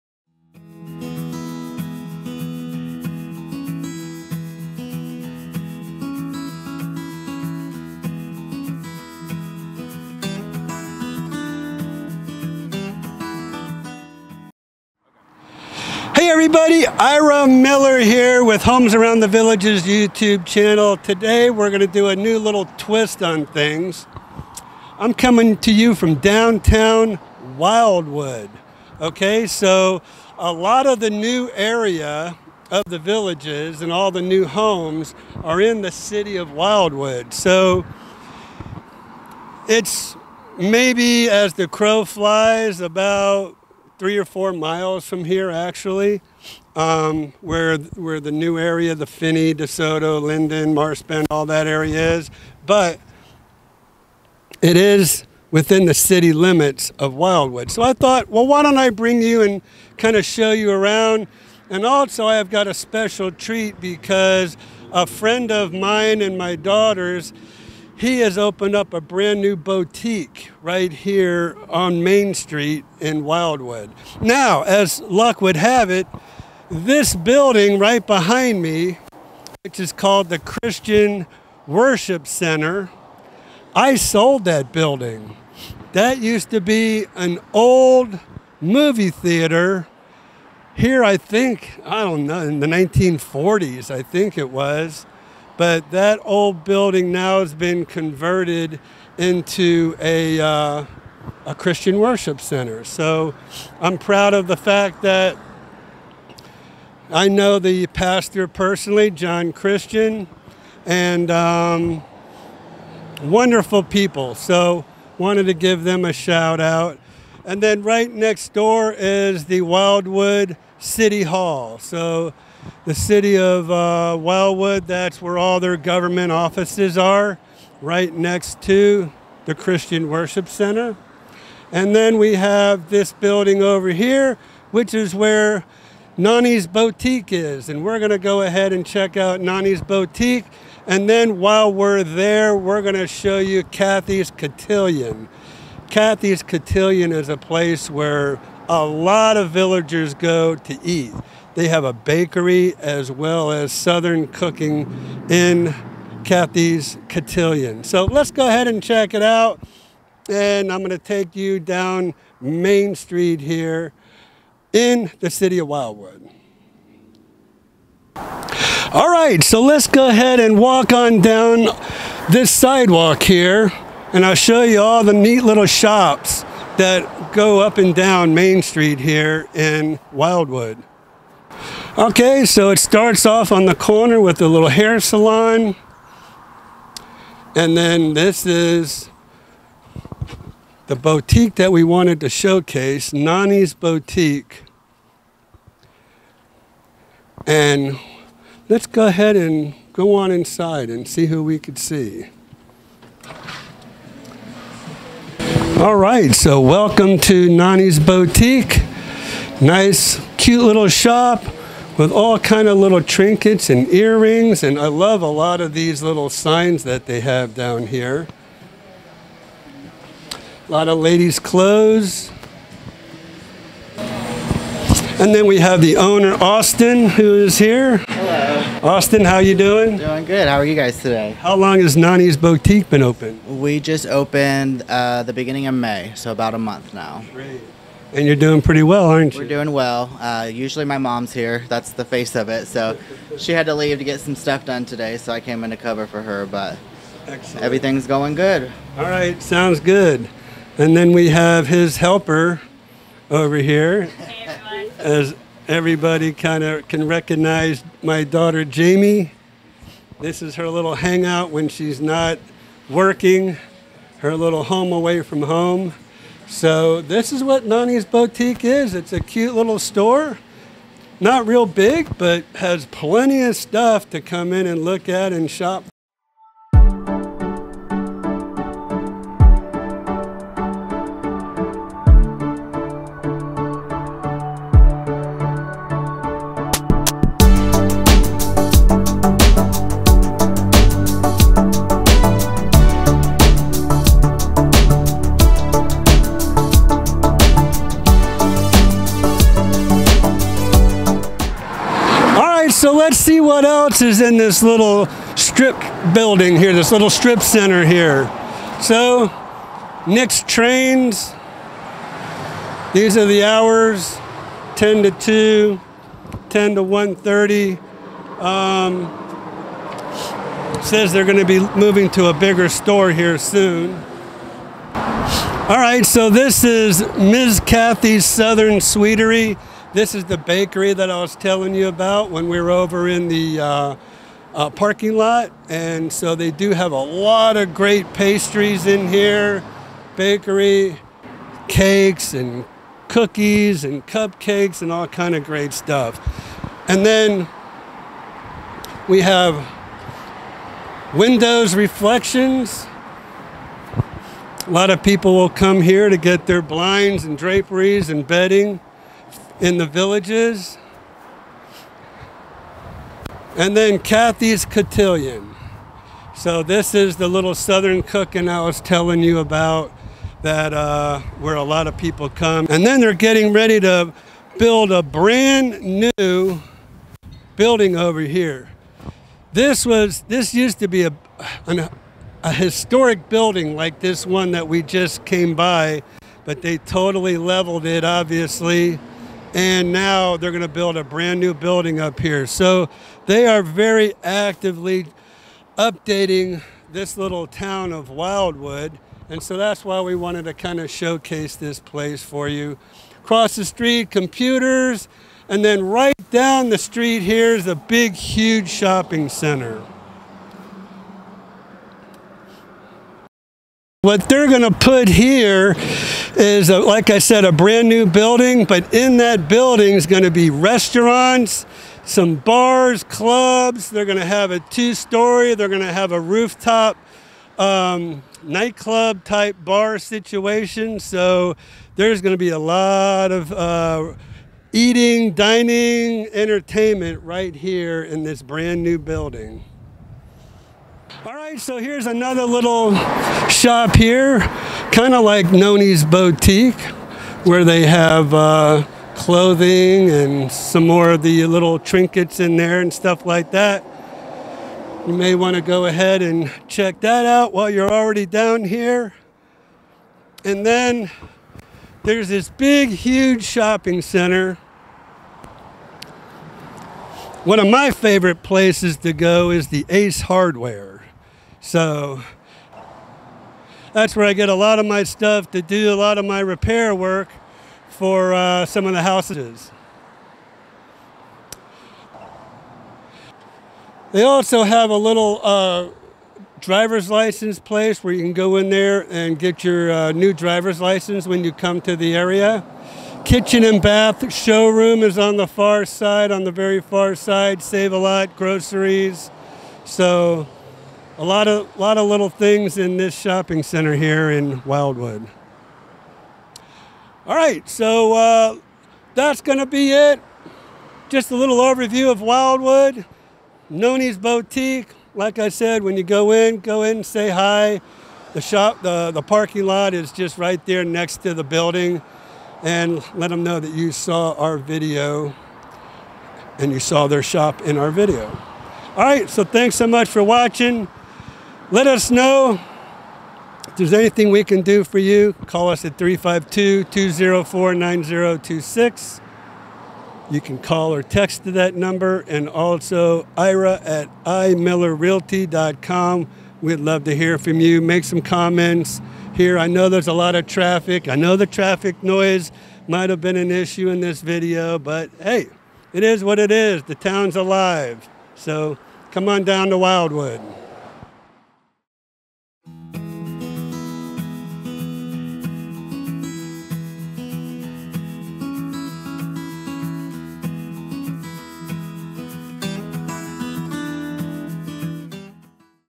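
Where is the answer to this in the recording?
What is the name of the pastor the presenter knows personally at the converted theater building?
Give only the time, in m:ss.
1:49.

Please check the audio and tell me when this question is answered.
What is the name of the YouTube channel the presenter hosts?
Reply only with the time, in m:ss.
0:18.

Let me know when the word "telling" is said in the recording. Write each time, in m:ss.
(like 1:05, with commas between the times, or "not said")
5:31, 6:08.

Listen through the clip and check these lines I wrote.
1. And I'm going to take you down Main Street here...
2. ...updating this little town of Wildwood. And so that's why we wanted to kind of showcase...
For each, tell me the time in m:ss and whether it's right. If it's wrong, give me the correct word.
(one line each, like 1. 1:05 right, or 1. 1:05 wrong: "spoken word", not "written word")
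1. 2:40 right
2. 6:35 right.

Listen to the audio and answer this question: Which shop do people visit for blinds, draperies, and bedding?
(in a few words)
Windows Reflections.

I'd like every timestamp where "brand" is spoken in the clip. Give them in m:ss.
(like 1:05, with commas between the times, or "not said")
1:08, 6:15, 6:31, 6:57, 7:18.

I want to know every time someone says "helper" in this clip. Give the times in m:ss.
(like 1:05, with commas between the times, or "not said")
4:11.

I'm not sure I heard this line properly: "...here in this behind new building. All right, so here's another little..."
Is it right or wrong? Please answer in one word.
wrong.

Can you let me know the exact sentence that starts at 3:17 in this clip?
And let's go ahead and go on inside and see who we could see.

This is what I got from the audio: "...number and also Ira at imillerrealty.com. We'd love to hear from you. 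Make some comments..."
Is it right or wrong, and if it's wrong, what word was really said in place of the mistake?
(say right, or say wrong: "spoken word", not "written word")
right.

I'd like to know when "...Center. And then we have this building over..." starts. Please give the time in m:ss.
2:10.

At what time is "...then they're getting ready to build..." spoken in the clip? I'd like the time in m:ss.
6:12.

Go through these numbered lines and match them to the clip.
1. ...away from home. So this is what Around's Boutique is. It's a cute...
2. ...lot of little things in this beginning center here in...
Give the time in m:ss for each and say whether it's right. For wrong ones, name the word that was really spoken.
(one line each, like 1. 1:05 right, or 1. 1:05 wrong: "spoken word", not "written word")
1. 4:24 wrong: "Nonnie", not "Around"
2. 8:21 wrong: "shopping", not "beginning".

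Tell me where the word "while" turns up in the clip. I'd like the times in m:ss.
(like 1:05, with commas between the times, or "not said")
2:21, 7:37.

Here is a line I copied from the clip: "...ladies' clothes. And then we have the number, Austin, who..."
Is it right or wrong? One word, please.
wrong.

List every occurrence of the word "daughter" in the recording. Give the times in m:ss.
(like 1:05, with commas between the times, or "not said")
1:06, 4:18.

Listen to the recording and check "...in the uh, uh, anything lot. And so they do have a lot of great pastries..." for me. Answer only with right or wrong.
wrong.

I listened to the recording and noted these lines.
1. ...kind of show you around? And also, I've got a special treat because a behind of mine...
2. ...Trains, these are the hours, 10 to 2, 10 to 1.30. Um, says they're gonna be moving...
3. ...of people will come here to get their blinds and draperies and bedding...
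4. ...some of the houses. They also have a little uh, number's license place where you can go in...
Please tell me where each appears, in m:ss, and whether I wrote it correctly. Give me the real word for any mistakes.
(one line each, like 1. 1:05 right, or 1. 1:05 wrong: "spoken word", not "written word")
1. 0:59 wrong: "friend", not "behind"
2. 5:10 right
3. 5:54 right
4. 7:58 wrong: "driver", not "number".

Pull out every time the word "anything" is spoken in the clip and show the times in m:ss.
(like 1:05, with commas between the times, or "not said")
8:53.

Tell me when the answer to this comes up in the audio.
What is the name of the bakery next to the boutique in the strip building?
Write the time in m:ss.
5:27.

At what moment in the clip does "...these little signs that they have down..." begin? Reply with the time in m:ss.
3:35.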